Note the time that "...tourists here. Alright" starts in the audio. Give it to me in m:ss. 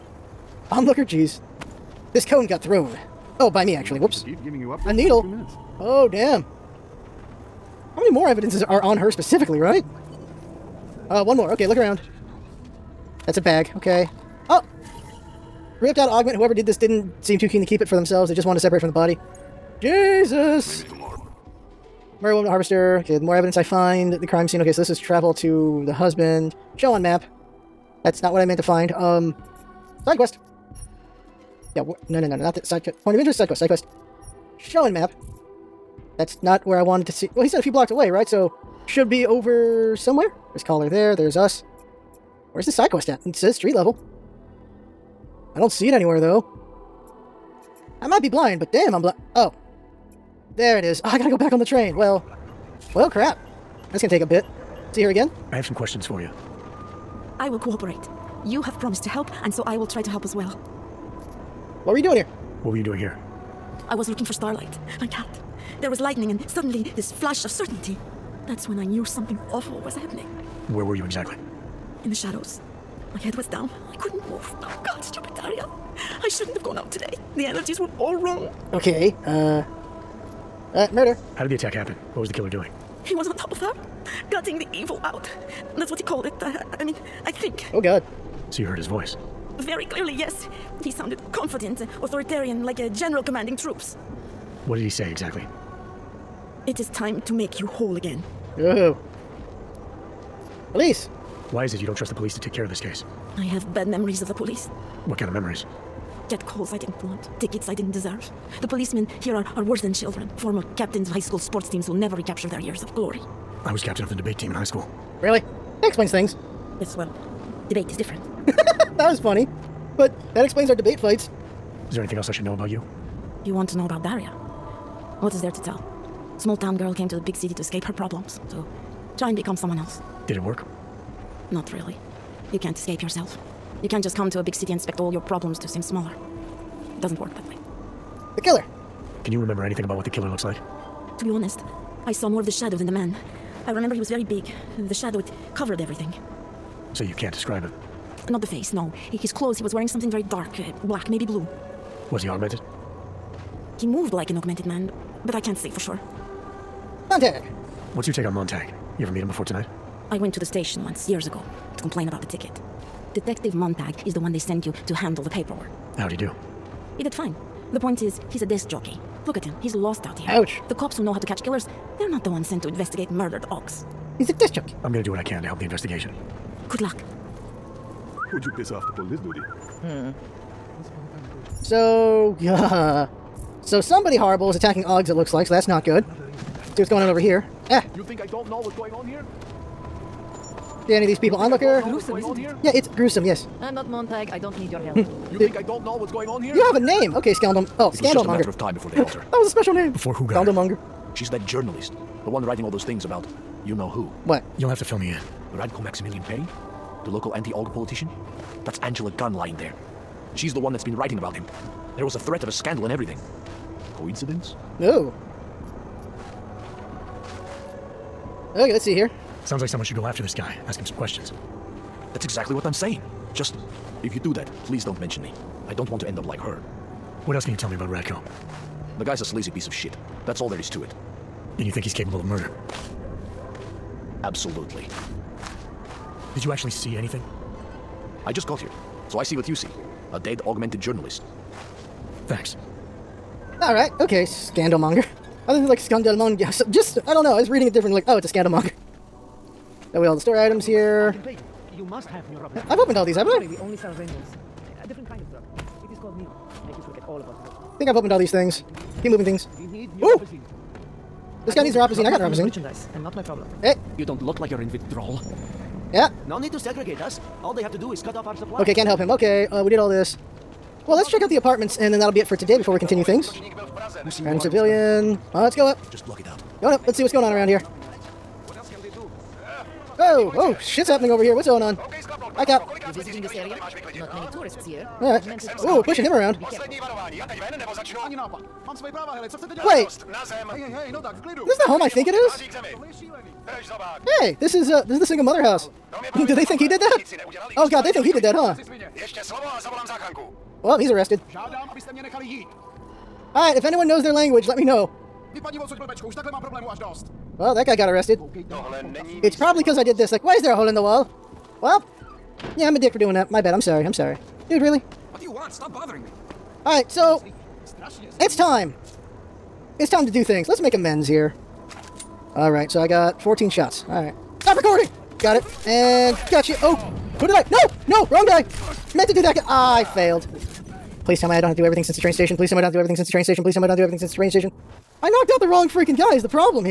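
4:44.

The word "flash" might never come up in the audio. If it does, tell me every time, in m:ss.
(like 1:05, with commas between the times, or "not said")
1:07.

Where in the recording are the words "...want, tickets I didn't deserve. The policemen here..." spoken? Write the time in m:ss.
1:47.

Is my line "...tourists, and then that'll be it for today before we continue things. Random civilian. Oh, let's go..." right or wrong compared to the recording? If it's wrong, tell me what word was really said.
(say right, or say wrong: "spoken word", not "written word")
wrong: "apartments", not "tourists".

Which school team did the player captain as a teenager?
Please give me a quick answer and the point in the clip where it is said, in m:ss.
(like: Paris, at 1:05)
Debate team, at 1:54.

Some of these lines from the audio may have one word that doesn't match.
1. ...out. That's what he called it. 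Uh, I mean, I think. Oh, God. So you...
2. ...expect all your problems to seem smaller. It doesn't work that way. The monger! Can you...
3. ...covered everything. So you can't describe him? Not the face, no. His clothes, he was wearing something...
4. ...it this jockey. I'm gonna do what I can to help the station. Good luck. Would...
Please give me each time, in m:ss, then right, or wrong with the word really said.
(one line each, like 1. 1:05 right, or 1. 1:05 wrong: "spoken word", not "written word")
1. 1:25 right
2. 2:14 wrong: "killer", not "monger"
3. 2:25 right
4. 2:54 wrong: "investigation", not "station".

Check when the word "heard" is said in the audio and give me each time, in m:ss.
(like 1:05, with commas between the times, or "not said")
1:28.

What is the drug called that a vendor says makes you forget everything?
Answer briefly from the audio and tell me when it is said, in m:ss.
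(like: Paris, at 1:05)
Neon, at 4:16.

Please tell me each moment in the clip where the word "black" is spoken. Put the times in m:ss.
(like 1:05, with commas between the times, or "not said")
2:30.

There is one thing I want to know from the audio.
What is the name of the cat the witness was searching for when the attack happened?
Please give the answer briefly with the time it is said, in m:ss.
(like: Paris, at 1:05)
Starlight, at 1:04.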